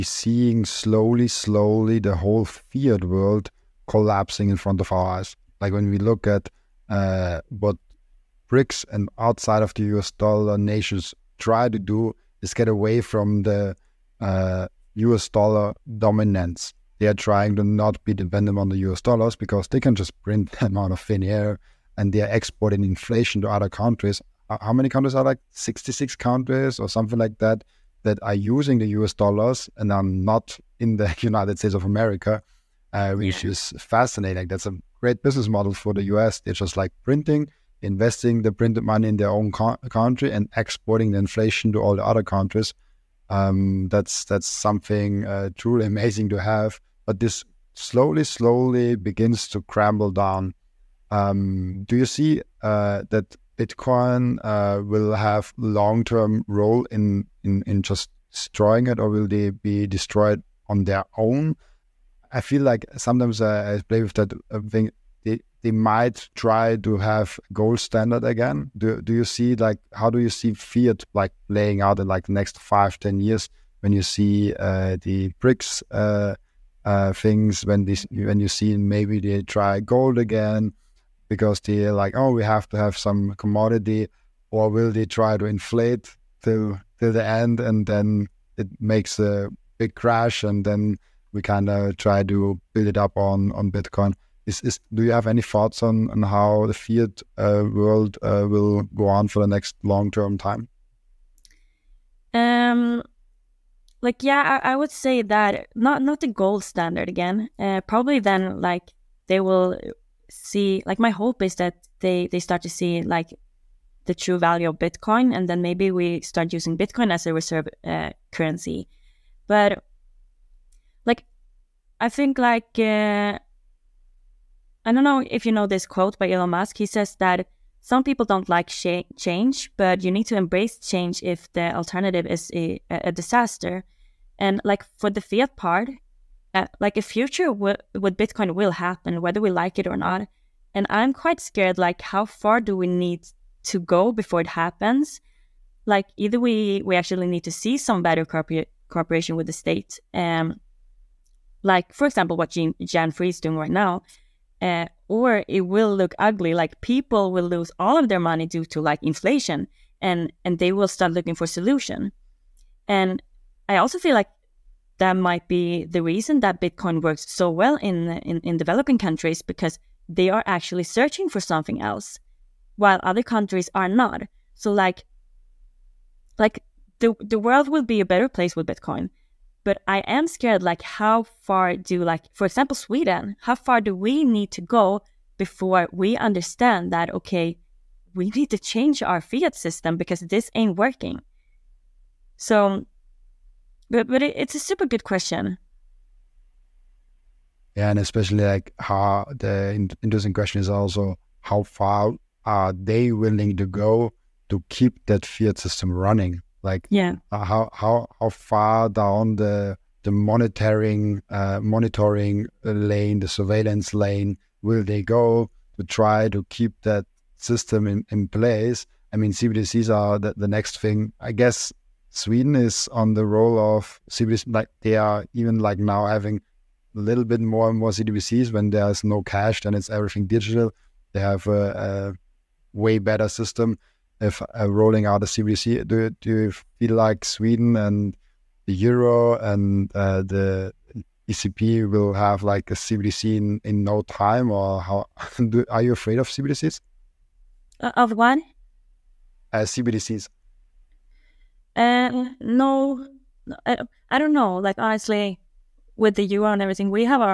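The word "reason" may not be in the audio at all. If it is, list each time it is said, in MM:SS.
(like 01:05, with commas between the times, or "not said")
02:46.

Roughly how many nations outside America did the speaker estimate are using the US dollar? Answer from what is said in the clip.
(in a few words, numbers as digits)
66.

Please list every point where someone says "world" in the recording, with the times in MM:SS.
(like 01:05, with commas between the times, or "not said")
00:03, 01:37, 02:57.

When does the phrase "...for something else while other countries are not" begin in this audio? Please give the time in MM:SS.
02:51.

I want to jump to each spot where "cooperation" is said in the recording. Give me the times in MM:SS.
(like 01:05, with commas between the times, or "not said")
02:28.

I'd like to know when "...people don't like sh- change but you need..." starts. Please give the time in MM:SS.
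02:08.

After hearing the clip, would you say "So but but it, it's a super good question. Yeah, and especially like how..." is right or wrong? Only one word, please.
right.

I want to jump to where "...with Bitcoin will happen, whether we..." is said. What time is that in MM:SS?
02:17.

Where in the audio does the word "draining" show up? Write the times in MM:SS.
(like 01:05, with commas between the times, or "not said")
not said.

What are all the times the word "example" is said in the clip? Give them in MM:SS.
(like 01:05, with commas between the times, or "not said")
02:32, 03:02.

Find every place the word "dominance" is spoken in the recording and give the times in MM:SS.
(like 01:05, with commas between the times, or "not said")
00:15.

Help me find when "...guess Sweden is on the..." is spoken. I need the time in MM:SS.
03:41.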